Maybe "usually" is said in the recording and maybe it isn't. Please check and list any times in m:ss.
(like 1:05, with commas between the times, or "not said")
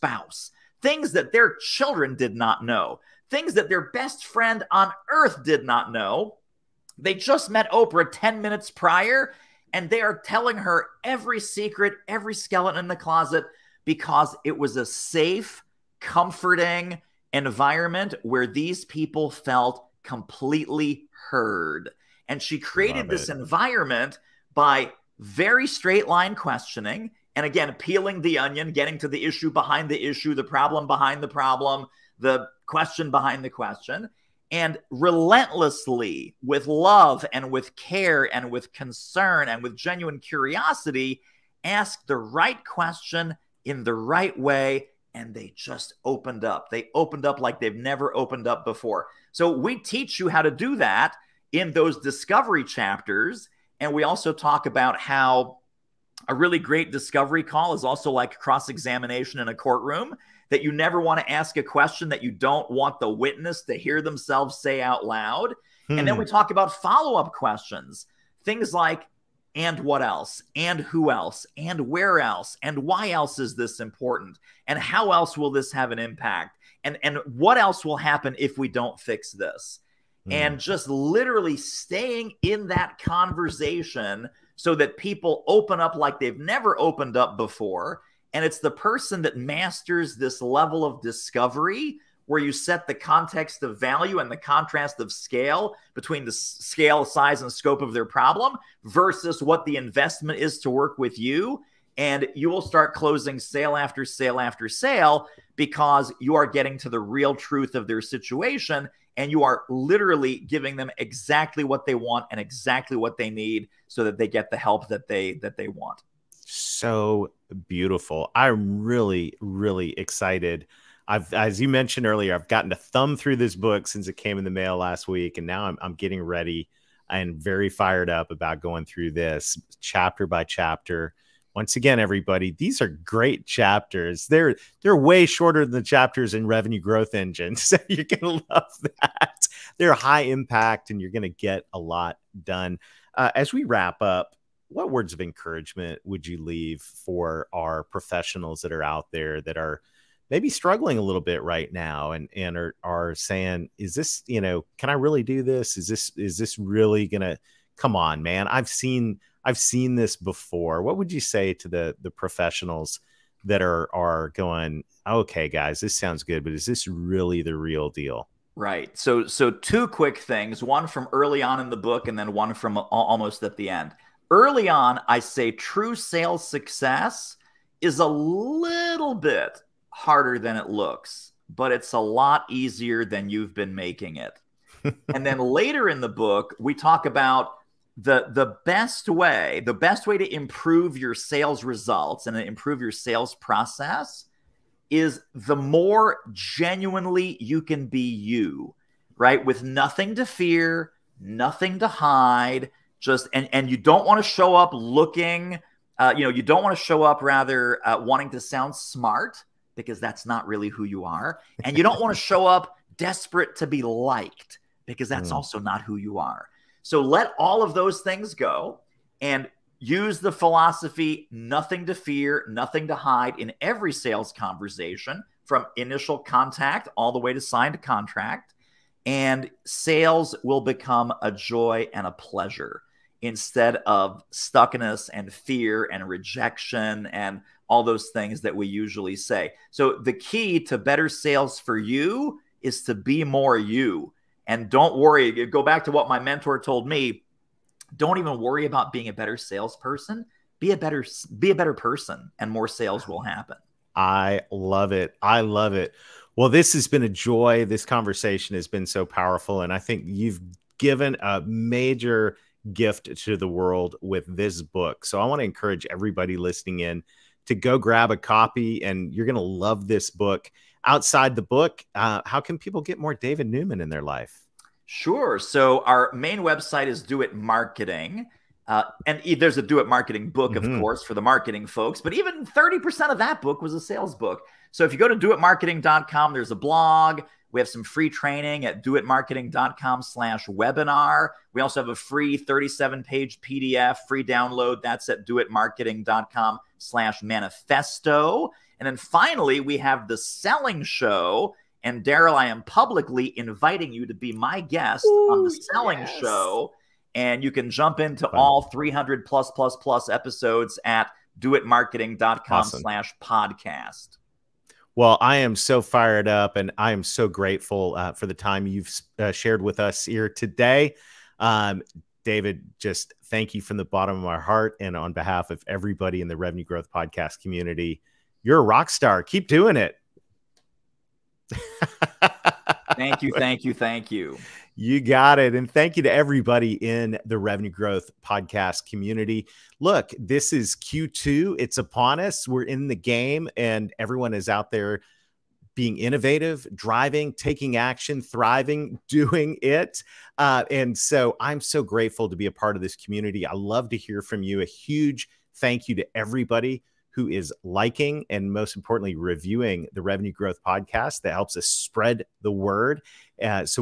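3:58.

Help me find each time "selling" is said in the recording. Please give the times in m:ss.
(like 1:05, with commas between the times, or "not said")
5:00, 5:05.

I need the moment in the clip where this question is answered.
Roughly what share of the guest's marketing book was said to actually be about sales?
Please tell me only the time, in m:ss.
4:42.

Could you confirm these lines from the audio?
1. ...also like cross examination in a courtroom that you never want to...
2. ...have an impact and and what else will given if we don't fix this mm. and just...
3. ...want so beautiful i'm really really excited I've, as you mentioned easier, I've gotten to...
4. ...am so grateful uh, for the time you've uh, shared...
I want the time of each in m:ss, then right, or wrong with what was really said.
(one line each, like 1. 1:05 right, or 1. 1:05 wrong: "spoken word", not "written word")
1. 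0:57 right
2. 1:15 wrong: "happen", not "given"
3. 1:55 wrong: "earlier", not "easier"
4. 5:16 right.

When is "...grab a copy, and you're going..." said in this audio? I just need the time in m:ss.
4:27.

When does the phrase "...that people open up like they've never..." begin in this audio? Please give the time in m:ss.
1:24.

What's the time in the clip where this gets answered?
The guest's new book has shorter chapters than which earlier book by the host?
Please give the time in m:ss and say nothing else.
2:16.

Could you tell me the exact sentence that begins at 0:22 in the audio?
And she created this environment by very straight line questioning.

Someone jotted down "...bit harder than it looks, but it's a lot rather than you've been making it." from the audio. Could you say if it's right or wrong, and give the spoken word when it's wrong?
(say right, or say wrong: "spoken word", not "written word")
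wrong: "easier", not "rather".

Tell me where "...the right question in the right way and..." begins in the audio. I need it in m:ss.
0:42.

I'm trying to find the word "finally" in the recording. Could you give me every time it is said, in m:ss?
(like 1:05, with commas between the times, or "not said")
4:58.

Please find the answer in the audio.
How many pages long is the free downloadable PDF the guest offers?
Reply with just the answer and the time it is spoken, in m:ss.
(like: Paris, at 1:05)
37, at 4:52.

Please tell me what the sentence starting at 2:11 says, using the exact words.
Once again, everybody, these are great chapters.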